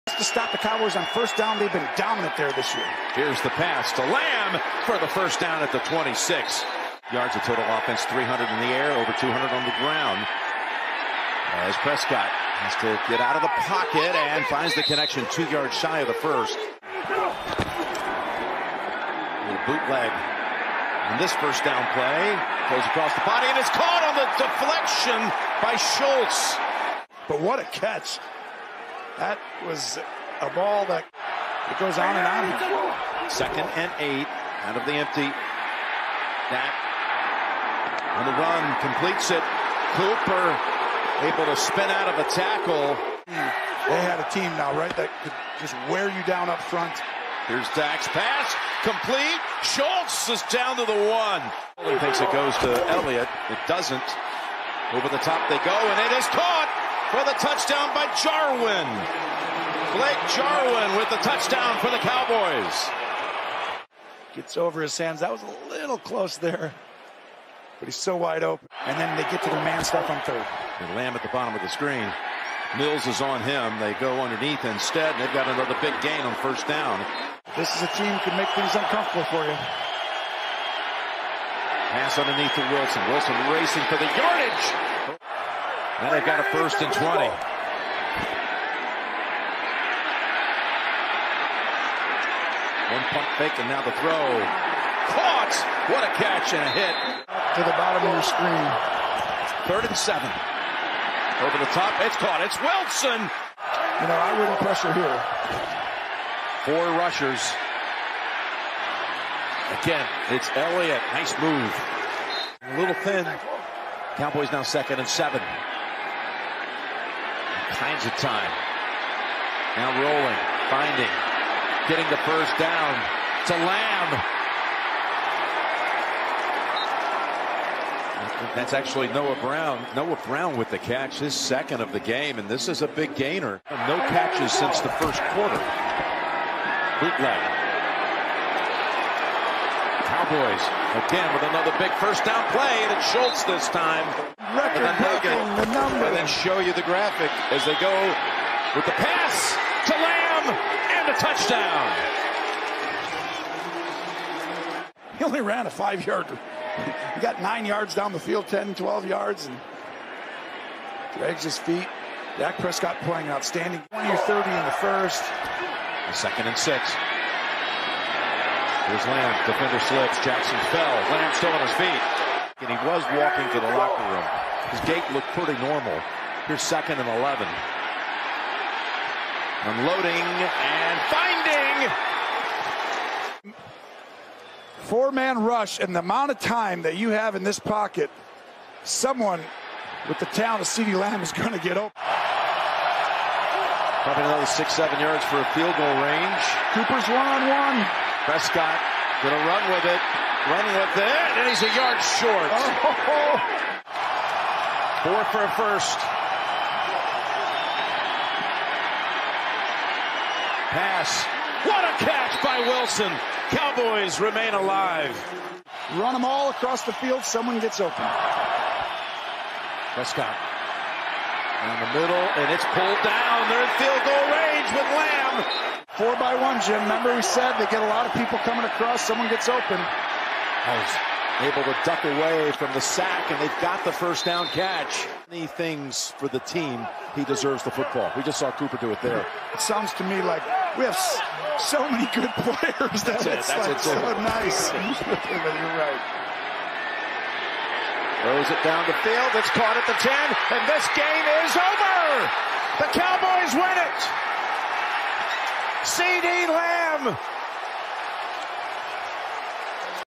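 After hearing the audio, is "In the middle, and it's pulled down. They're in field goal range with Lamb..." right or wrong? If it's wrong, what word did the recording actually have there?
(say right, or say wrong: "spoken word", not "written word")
right.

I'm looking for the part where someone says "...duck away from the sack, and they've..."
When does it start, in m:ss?
3:51.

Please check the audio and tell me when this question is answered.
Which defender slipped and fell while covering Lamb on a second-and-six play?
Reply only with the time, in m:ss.
2:50.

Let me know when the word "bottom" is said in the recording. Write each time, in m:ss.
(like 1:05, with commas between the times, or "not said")
1:11, 1:37.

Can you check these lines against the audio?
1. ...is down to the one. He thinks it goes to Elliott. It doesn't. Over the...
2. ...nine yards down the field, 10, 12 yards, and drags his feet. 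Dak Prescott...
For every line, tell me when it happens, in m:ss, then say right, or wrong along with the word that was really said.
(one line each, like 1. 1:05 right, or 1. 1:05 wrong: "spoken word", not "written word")
1. 0:50 right
2. 2:37 right.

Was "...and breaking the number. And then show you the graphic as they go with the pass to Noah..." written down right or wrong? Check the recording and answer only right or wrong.
wrong.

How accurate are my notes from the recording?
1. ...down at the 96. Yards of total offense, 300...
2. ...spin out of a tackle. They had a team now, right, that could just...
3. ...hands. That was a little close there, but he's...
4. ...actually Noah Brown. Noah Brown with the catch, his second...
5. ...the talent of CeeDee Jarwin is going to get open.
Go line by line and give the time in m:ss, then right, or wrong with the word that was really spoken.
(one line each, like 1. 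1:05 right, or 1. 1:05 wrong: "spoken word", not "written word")
1. 0:05 wrong: "26", not "96"
2. 0:41 right
3. 1:04 right
4. 2:08 right
5. 3:10 wrong: "Lamb", not "Jarwin".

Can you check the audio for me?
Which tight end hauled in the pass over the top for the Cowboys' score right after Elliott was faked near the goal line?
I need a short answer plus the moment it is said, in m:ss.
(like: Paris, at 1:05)
Blake Jarwin, at 0:59.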